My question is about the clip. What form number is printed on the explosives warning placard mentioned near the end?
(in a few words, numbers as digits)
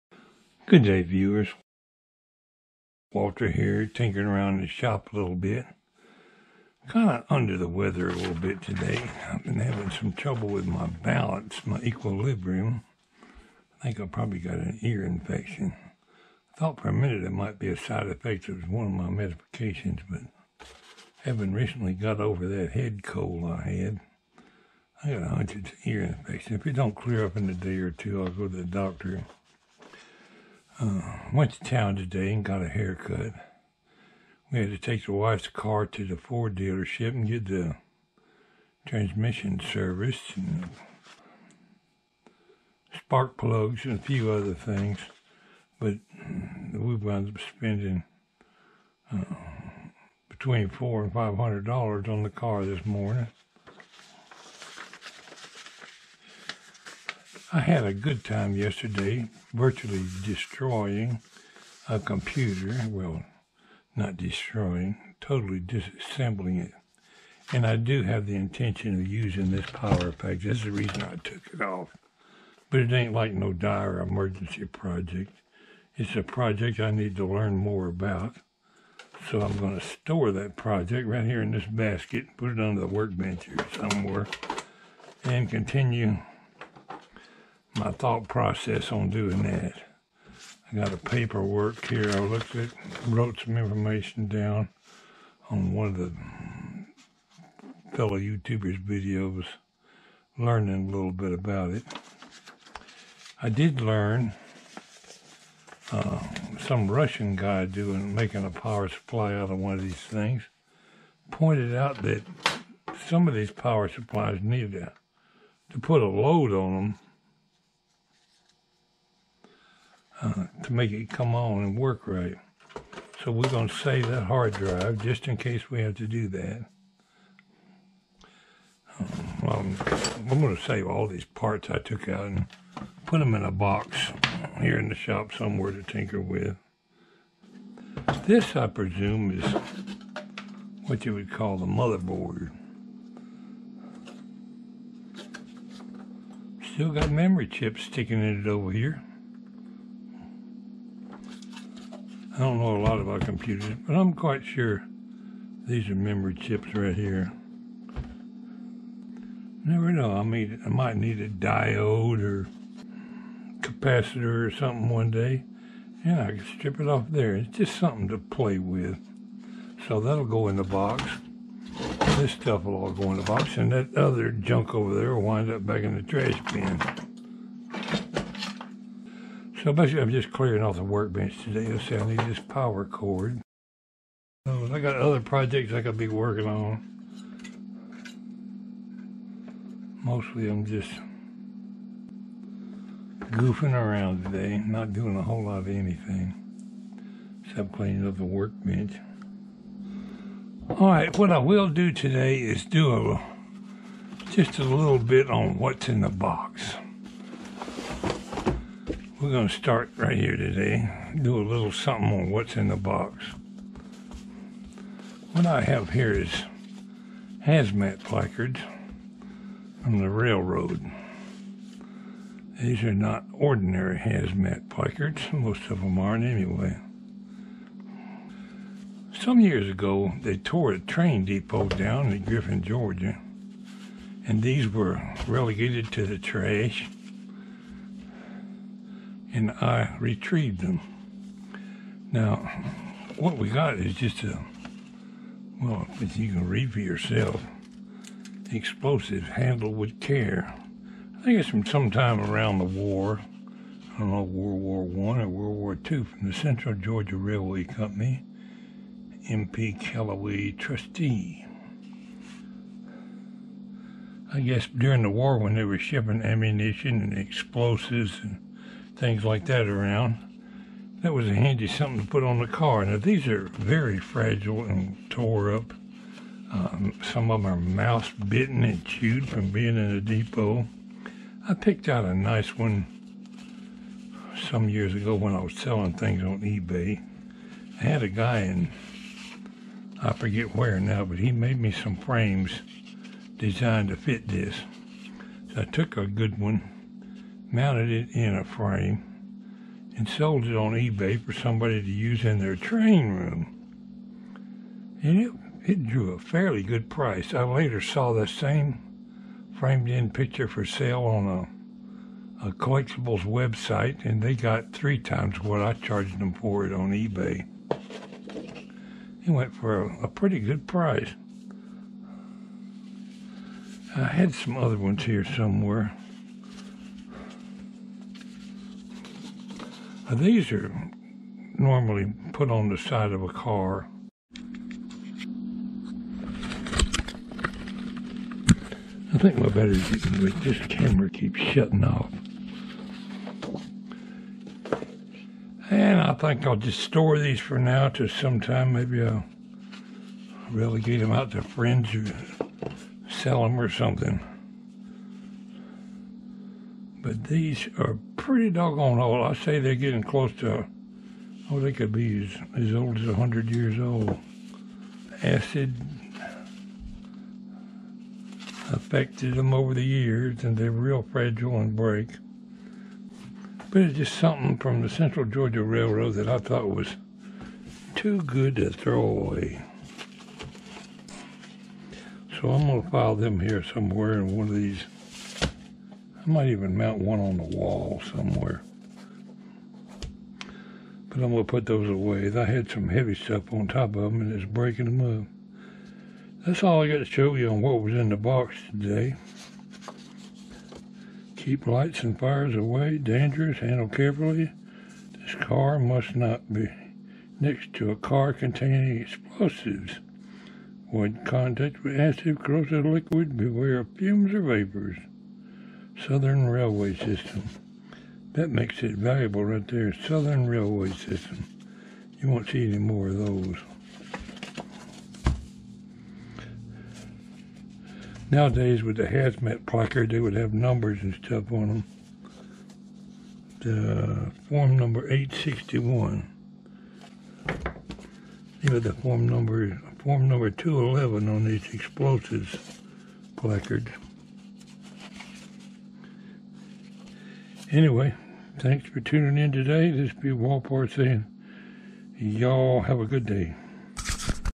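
211.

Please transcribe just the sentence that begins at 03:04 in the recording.
So oh, I got other projects I could be working on.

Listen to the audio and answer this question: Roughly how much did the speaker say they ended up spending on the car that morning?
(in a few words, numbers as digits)
$400 to $500.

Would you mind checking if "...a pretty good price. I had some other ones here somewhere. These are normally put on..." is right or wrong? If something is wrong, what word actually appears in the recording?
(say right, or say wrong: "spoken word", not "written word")
right.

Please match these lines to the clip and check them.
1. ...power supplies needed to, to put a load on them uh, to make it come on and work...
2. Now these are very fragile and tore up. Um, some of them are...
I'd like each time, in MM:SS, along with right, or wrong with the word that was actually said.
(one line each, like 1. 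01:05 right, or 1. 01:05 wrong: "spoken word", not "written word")
1. 01:53 right
2. 04:32 right.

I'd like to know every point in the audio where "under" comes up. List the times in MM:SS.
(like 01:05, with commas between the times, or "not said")
00:07, 01:22.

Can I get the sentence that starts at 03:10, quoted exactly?
Mostly, I'm just goofing around today, not doing a whole lot of anything except cleaning up the workbench.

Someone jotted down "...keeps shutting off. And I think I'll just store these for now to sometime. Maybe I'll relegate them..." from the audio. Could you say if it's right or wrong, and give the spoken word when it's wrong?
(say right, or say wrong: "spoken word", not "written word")
right.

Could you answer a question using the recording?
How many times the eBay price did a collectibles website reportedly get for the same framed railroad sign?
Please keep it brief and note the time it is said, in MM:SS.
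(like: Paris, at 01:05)
3 times, at 05:14.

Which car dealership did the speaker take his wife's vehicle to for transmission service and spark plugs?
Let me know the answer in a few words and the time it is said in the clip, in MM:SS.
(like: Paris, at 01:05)
Ford, at 00:36.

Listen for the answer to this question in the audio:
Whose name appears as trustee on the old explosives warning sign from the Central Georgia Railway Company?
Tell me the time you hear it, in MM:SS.
04:19.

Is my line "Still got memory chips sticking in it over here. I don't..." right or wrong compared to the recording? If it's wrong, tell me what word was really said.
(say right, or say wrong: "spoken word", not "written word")
right.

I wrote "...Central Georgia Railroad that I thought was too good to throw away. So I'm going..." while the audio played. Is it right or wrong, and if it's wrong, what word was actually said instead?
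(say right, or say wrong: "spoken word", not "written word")
right.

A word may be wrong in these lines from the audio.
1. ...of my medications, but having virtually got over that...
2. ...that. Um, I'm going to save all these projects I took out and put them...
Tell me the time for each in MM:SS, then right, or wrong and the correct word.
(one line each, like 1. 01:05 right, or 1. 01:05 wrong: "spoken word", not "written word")
1. 00:18 wrong: "recently", not "virtually"
2. 02:06 wrong: "parts", not "projects".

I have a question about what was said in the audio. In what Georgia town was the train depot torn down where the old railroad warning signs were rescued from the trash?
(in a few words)
Griffin.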